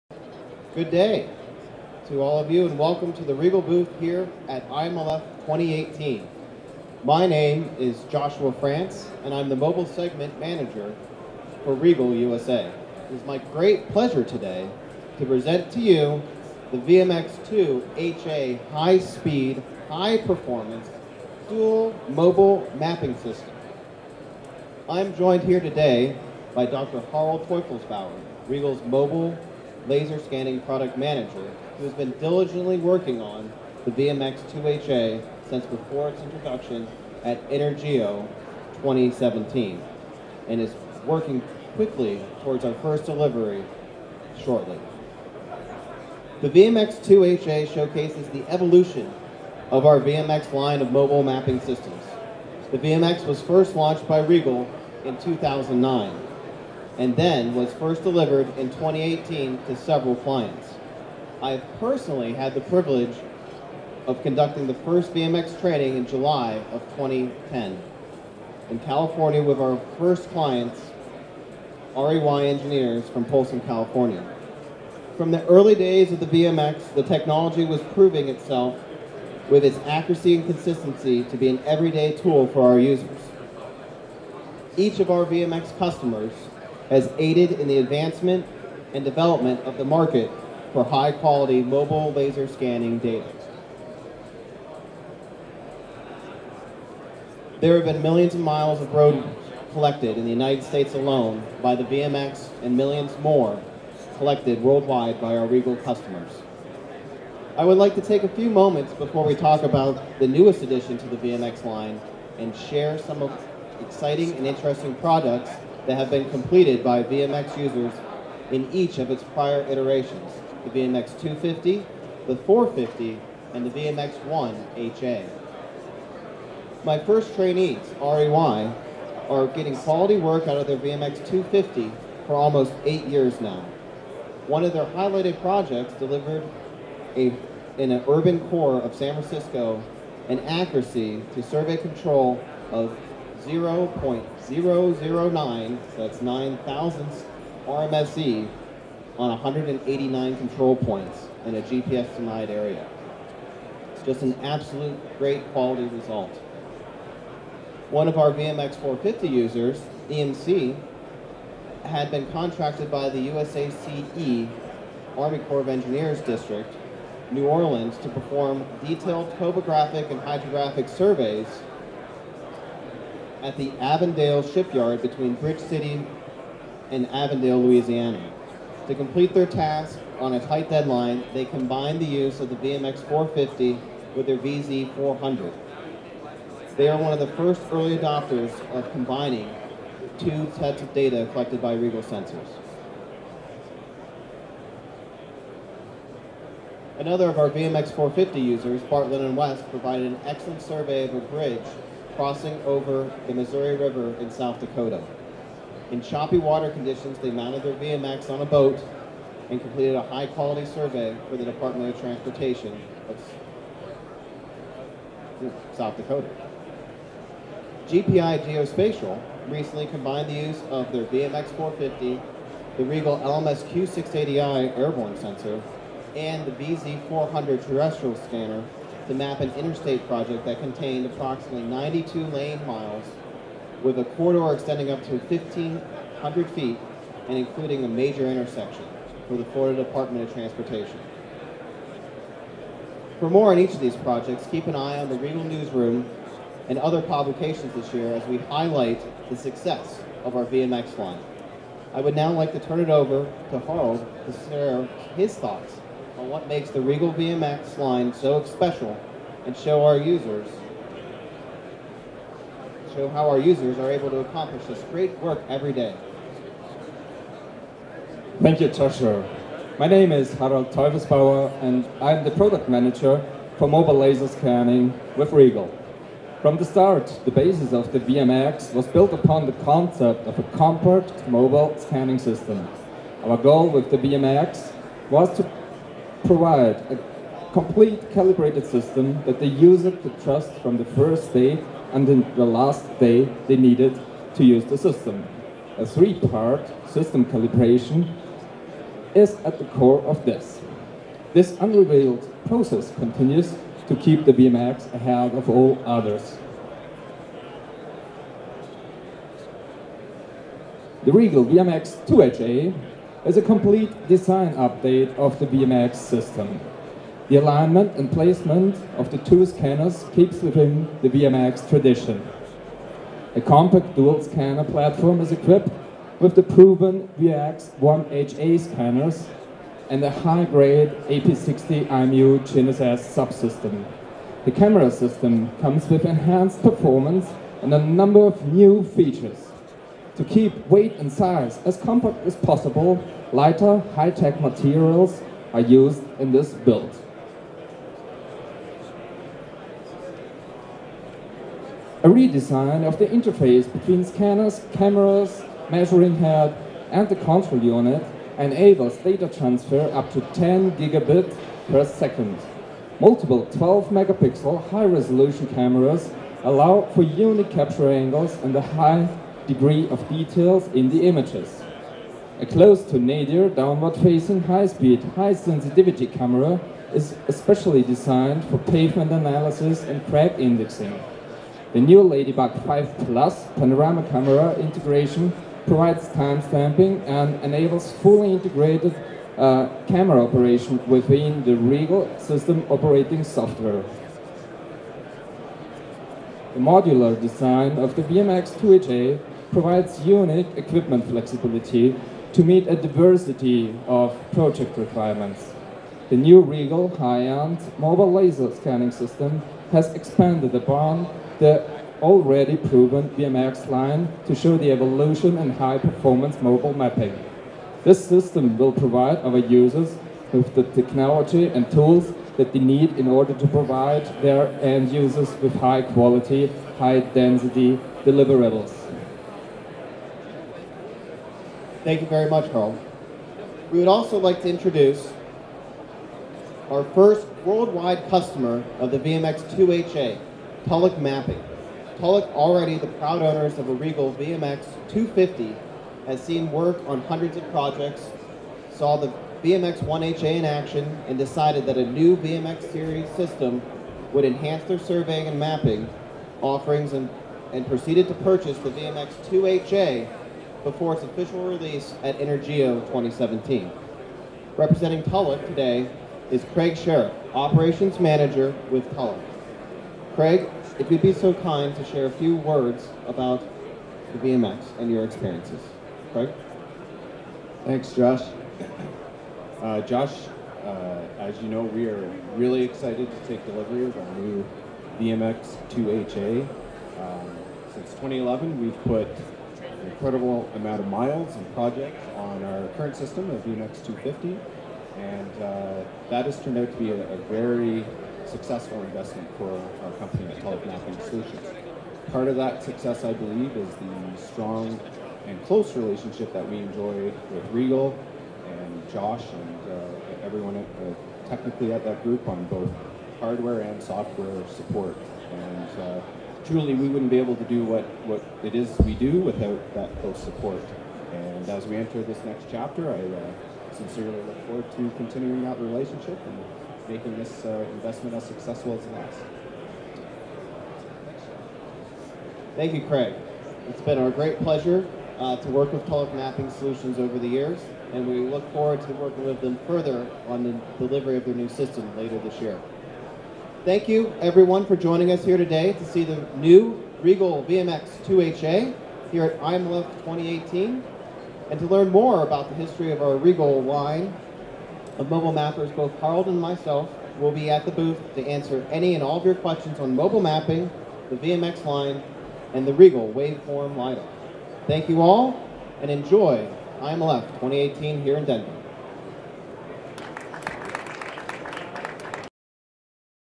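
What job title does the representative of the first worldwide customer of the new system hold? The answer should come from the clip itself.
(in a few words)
Operations Manager.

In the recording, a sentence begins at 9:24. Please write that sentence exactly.
Thank you all, and enjoy I'm Left 2018 here in Denver.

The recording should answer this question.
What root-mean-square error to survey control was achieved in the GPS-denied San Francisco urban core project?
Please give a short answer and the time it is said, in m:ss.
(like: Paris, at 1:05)
0.009, at 2:23.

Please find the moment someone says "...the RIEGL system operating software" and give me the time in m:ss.
6:31.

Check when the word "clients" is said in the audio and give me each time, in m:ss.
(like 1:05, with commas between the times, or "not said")
1:00, 1:10.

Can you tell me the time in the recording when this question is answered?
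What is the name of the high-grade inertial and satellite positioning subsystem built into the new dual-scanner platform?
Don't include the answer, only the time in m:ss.
5:31.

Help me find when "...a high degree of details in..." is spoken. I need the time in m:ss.
6:08.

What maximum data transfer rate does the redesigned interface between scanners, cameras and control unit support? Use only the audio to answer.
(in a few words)
10 gigabits per second.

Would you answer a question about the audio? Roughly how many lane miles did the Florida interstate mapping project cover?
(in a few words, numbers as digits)
92.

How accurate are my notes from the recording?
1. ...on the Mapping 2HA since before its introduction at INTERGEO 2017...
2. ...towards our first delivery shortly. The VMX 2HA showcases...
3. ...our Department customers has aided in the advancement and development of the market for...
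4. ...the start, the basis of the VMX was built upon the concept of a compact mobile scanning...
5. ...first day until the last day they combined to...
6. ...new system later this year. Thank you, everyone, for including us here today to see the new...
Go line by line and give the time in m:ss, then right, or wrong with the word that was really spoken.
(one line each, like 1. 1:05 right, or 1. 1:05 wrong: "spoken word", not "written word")
1. 0:33 wrong: "VMX", not "Mapping"
2. 0:42 right
3. 1:25 wrong: "VMX", not "Department"
4. 4:36 right
5. 4:50 wrong: "needed", not "combined"
6. 9:01 wrong: "joining", not "including".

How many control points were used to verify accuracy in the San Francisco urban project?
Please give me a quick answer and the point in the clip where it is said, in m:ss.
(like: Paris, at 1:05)
189, at 2:29.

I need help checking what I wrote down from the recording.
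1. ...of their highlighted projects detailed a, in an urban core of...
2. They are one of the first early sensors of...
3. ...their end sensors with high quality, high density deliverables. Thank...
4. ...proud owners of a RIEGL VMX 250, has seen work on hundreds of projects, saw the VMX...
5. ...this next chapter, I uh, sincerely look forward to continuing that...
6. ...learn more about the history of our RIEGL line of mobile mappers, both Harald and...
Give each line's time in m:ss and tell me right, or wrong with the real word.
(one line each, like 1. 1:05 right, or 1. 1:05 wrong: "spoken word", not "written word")
1. 2:14 wrong: "delivered", not "detailed"
2. 3:06 wrong: "adopters", not "sensors"
3. 7:04 wrong: "users", not "sensors"
4. 7:22 right
5. 8:42 right
6. 9:11 right.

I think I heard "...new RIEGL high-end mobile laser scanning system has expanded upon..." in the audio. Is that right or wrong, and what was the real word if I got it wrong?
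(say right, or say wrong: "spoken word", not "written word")
right.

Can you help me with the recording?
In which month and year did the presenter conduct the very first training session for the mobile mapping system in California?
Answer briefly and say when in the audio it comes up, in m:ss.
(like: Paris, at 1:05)
July 2010, at 1:06.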